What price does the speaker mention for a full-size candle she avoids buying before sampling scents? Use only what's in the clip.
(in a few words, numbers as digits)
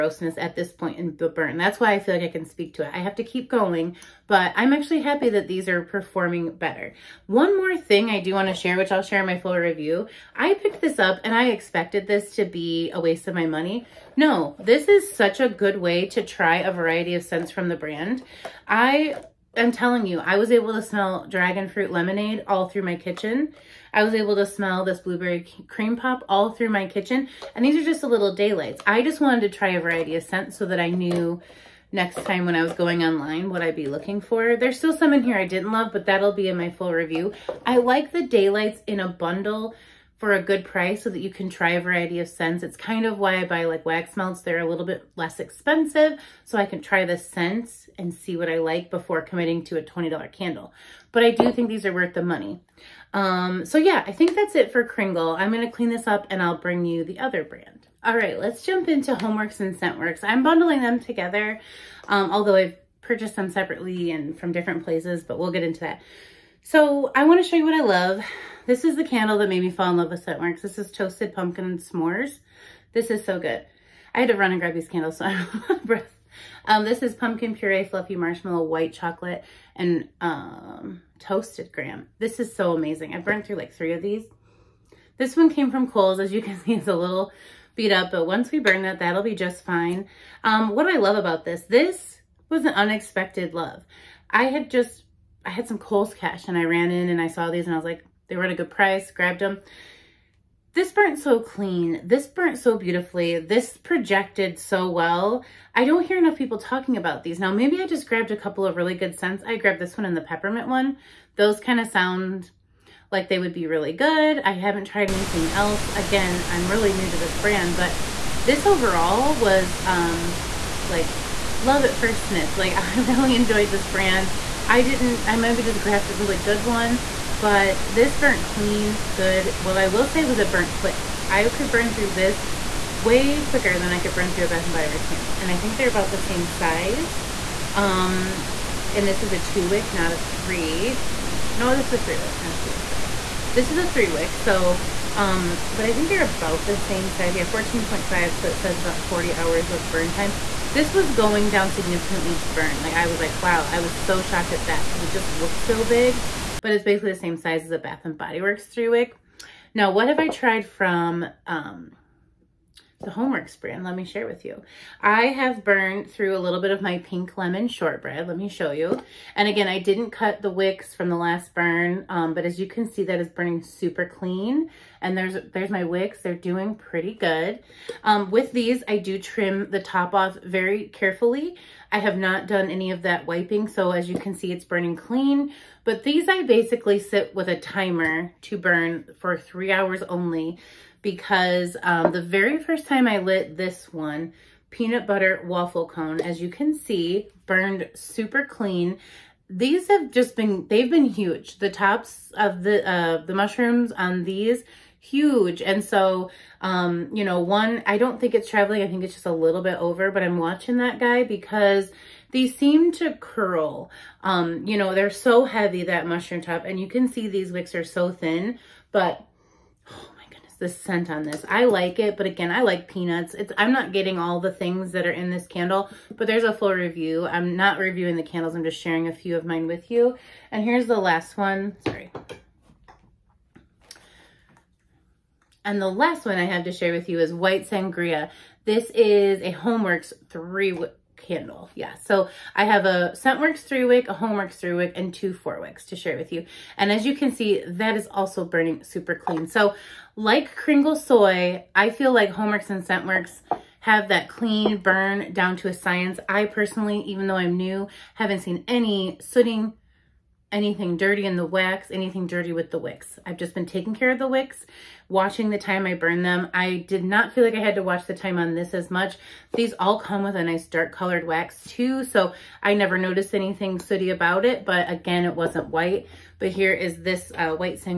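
$20.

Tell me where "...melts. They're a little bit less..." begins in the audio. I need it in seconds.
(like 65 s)
44 s.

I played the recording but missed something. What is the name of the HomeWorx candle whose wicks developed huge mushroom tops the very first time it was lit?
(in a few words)
Peanut Butter Waffle Cone.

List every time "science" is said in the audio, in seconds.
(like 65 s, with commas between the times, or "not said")
255 s.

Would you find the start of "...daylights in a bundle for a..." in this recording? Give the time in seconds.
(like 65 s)
38 s.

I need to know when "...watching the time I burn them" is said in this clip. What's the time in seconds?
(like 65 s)
265 s.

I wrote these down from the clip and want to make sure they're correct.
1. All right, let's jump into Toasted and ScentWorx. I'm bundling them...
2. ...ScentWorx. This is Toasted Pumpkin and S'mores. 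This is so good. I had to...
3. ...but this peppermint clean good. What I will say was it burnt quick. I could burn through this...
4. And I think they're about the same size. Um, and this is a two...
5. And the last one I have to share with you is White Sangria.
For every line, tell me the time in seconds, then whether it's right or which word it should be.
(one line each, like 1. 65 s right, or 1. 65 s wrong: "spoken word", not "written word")
1. 58 s wrong: "HomeWorx", not "Toasted"
2. 70 s right
3. 127 s wrong: "burnt", not "peppermint"
4. 135 s right
5. 235 s right.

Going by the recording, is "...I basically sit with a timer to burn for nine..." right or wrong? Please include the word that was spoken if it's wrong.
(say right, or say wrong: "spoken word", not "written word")
wrong: "three", not "nine".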